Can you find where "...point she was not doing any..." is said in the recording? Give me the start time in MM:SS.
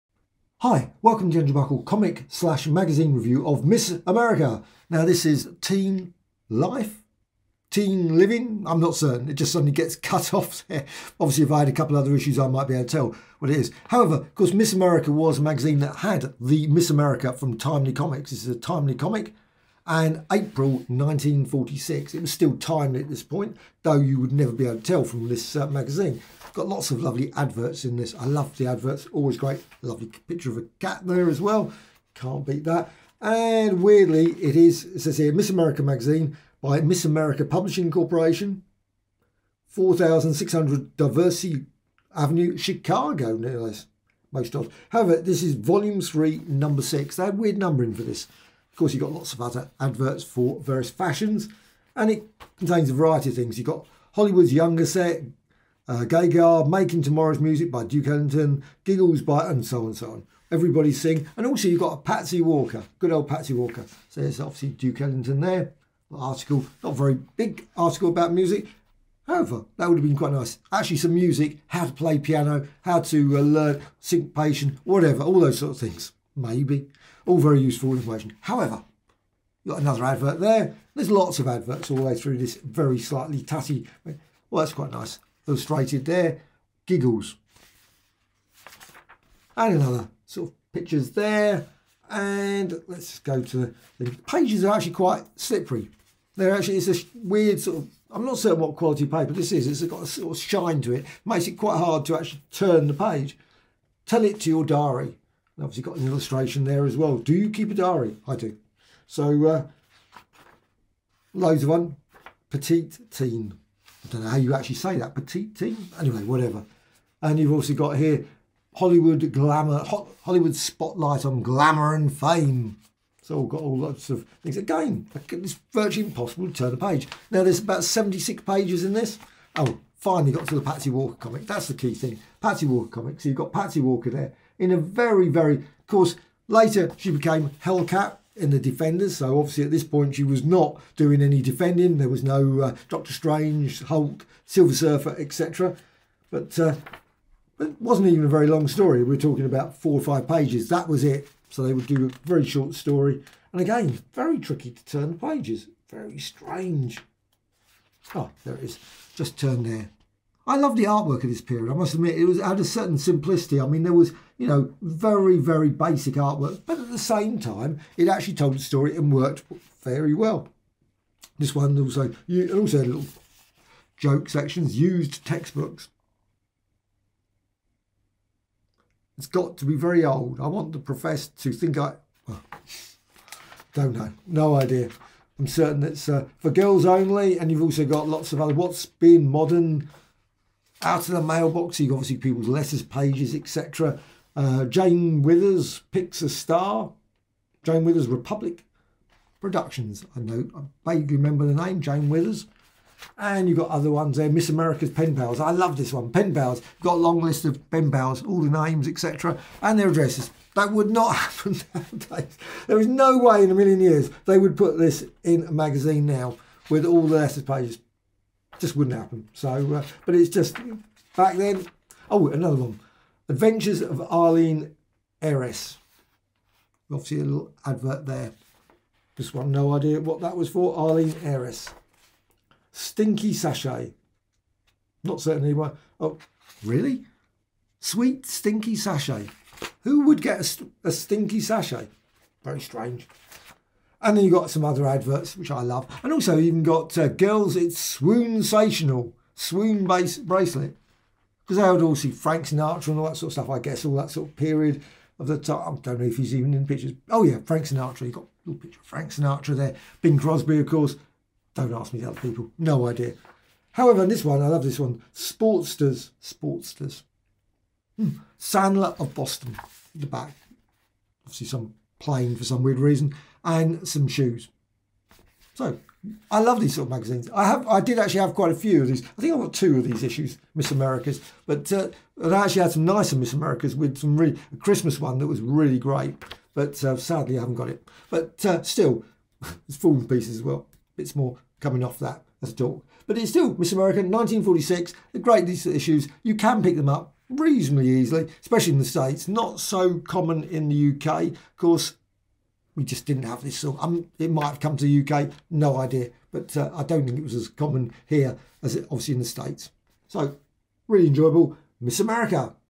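02:19.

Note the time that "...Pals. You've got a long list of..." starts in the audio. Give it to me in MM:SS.
03:26.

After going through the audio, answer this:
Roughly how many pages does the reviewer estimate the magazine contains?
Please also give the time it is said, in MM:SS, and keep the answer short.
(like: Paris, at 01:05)
76, at 02:07.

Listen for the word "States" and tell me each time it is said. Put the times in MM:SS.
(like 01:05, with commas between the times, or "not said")
04:58, 05:09.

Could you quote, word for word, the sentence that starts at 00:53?
You've got Hollywood's Younger Set, uh, Gagar, Making Tomorrow's Music by Duke Ellington, Giggles by, and so on and so on.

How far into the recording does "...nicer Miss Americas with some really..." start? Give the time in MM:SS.
04:42.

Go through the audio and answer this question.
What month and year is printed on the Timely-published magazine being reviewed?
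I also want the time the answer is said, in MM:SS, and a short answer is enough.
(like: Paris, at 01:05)
April 1946, at 00:20.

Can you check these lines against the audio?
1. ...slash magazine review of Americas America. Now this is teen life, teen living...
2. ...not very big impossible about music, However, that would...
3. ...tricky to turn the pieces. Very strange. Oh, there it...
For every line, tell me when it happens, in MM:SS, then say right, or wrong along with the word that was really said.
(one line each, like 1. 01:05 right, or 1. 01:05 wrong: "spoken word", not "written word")
1. 00:02 wrong: "Miss", not "Americas"
2. 01:06 wrong: "article", not "impossible"
3. 02:34 wrong: "pages", not "pieces".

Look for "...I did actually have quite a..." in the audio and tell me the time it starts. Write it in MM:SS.
04:37.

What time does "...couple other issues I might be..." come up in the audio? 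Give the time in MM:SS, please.
00:11.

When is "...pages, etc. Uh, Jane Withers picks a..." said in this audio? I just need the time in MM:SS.
03:12.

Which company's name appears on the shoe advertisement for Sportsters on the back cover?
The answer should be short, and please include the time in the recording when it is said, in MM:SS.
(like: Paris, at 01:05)
Sandler of Boston, at 04:28.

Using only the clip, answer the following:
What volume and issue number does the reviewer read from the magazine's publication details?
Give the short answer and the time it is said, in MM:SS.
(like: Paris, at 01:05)
Volume 3, number 6, at 00:45.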